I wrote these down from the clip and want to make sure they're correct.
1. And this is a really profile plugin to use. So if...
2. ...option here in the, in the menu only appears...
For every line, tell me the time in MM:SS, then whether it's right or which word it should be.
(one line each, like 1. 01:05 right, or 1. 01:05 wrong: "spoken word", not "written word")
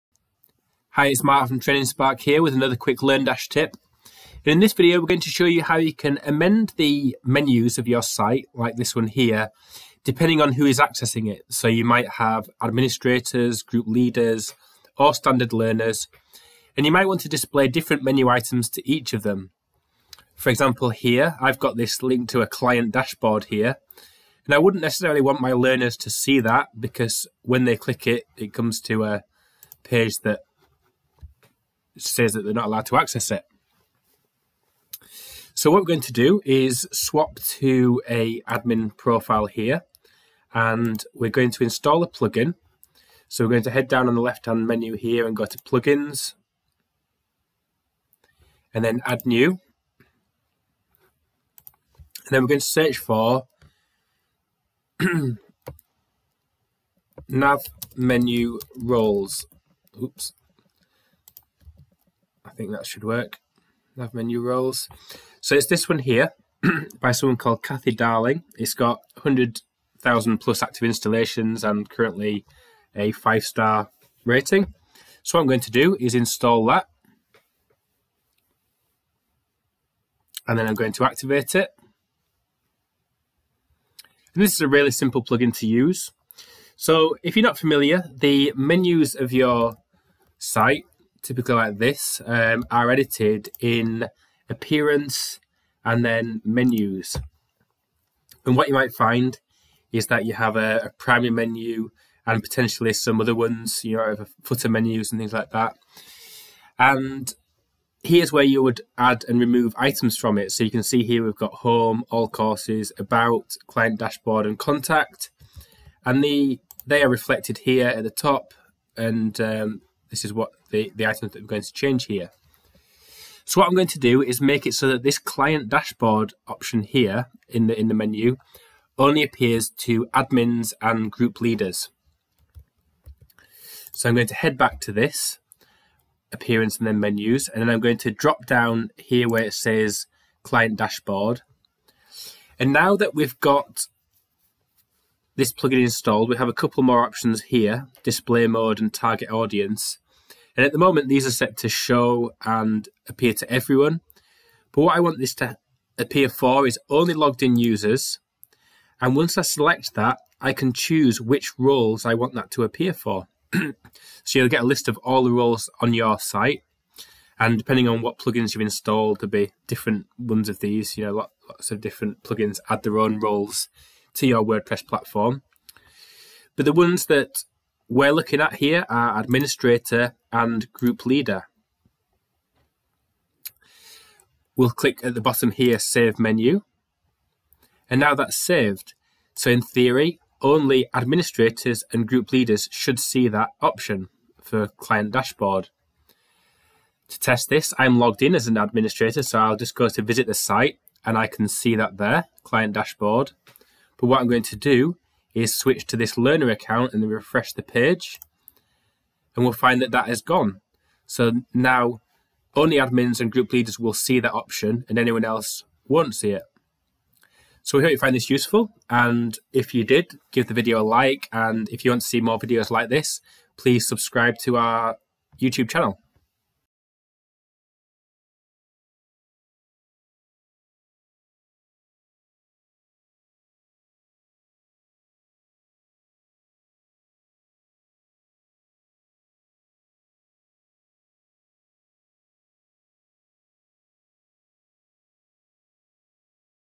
1. 01:24 wrong: "simple", not "profile"
2. 02:06 right.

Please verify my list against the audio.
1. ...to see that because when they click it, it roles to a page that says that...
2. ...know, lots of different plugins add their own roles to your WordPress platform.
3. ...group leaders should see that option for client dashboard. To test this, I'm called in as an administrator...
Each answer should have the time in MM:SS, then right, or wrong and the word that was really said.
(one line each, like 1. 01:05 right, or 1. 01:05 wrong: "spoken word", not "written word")
1. 00:25 wrong: "comes", not "roles"
2. 02:51 right
3. 03:12 wrong: "logged", not "called".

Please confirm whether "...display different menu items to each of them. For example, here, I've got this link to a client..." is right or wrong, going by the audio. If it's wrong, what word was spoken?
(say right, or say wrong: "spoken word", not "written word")
right.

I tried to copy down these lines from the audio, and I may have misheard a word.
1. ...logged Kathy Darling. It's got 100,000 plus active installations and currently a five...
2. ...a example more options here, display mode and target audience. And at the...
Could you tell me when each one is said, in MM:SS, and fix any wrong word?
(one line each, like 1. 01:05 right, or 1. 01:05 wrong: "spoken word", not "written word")
1. 01:07 wrong: "called", not "logged"
2. 02:26 wrong: "couple", not "example".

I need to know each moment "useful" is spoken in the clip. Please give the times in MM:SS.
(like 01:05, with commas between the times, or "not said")
03:38.